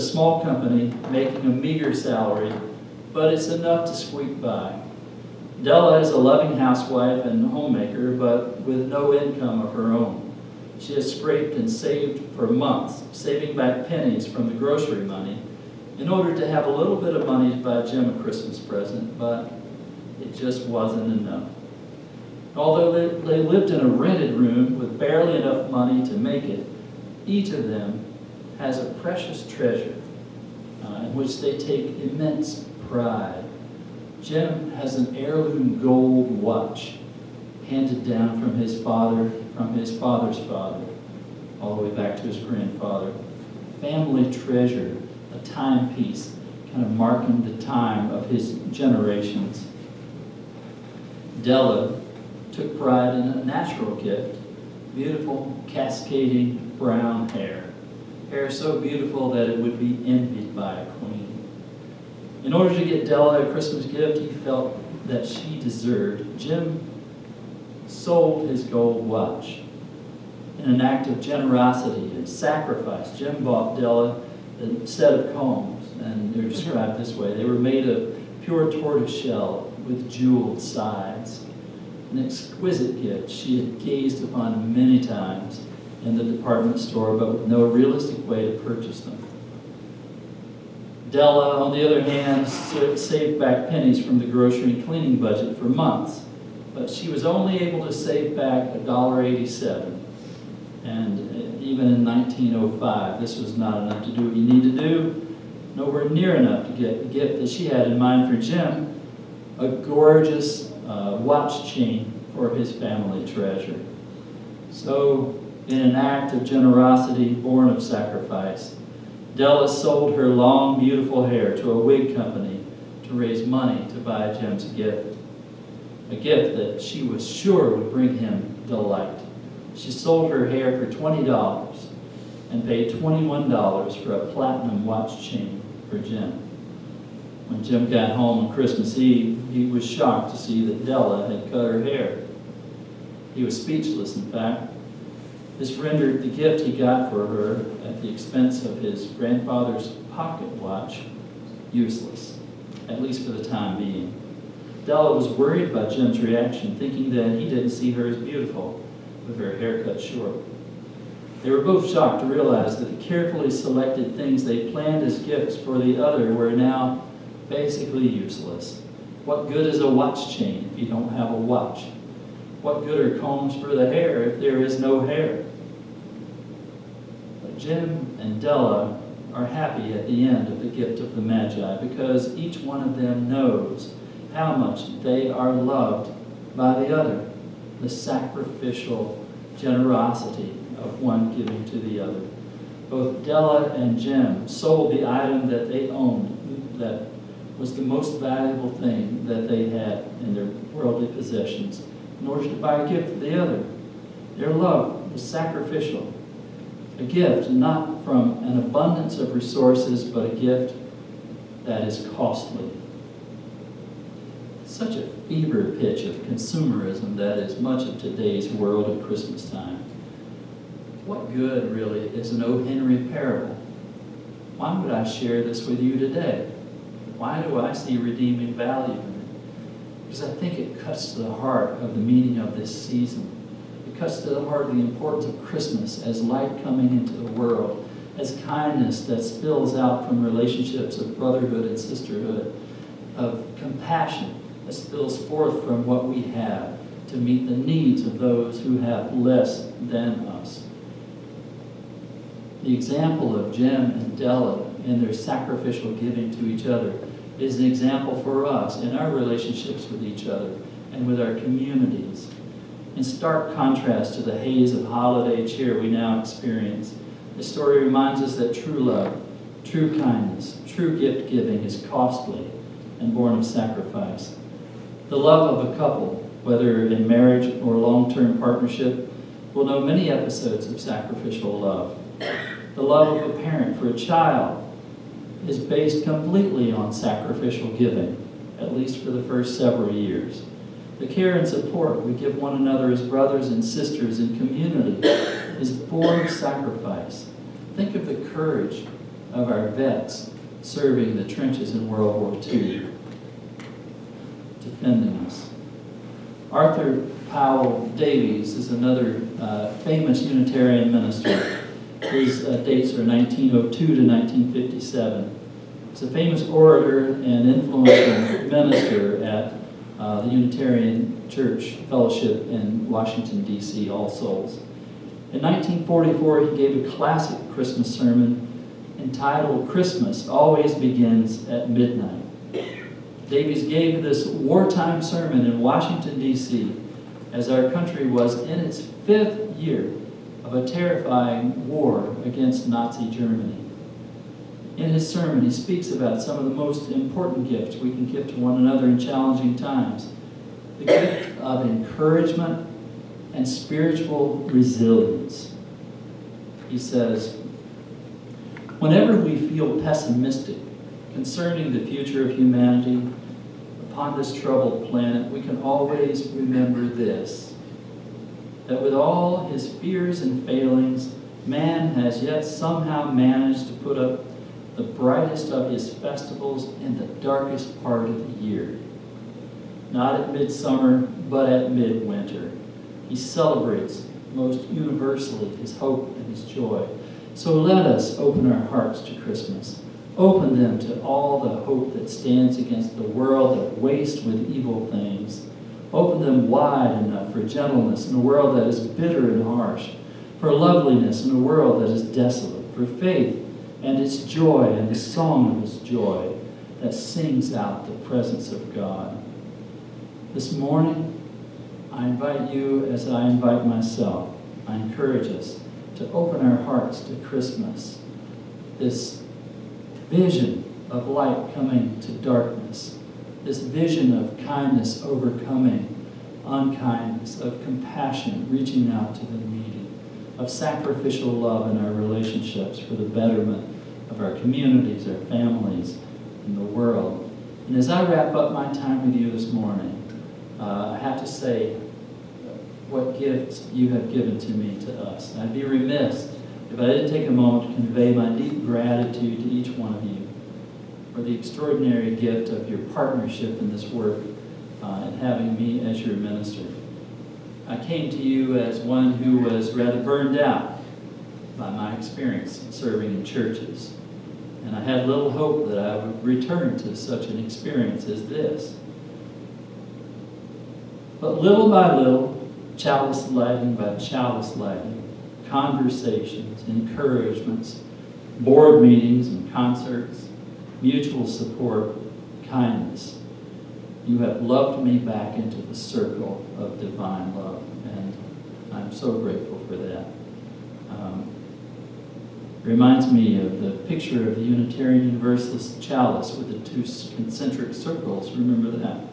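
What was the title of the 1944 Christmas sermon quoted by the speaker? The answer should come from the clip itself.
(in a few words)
Christmas Always Begins at Midnight.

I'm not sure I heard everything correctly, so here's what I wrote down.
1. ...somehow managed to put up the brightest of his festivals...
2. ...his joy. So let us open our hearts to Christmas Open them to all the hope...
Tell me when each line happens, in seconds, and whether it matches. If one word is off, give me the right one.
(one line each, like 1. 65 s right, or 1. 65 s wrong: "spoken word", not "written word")
1. 372 s right
2. 386 s right.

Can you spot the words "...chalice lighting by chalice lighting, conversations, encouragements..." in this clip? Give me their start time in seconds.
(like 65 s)
472 s.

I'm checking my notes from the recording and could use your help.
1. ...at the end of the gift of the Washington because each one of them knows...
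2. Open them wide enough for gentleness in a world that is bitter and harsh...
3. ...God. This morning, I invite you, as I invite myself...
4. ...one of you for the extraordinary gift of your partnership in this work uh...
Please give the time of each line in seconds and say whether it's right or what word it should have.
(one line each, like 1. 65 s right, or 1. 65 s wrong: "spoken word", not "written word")
1. 179 s wrong: "Magi", not "Washington"
2. 395 s right
3. 408 s right
4. 449 s right.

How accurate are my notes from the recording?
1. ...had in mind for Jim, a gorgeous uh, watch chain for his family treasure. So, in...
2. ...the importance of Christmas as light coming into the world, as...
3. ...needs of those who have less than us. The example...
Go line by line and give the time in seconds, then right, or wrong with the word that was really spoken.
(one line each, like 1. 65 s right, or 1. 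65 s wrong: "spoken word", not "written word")
1. 107 s right
2. 234 s right
3. 247 s right.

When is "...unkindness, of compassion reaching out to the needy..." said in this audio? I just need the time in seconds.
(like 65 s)
426 s.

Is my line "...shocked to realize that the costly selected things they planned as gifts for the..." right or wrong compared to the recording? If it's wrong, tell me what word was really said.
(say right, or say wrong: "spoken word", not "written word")
wrong: "carefully", not "costly".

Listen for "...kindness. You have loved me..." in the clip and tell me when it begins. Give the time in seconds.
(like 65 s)
482 s.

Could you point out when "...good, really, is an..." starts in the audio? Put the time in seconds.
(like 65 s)
221 s.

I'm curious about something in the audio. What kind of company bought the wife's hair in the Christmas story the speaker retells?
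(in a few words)
a wig company.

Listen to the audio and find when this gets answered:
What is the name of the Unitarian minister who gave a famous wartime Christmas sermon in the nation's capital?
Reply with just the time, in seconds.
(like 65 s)
306 s.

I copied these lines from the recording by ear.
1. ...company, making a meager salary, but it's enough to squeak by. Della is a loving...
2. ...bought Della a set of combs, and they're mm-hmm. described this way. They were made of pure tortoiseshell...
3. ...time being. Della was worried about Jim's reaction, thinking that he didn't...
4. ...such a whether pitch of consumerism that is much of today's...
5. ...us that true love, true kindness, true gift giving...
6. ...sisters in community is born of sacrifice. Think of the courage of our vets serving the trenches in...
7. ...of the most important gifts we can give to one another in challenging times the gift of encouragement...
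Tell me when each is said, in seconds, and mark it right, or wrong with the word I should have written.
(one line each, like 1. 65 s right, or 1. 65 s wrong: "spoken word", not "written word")
1. 0 s right
2. 73 s right
3. 153 s right
4. 214 s wrong: "fever", not "whether"
5. 268 s right
6. 293 s right
7. 346 s right.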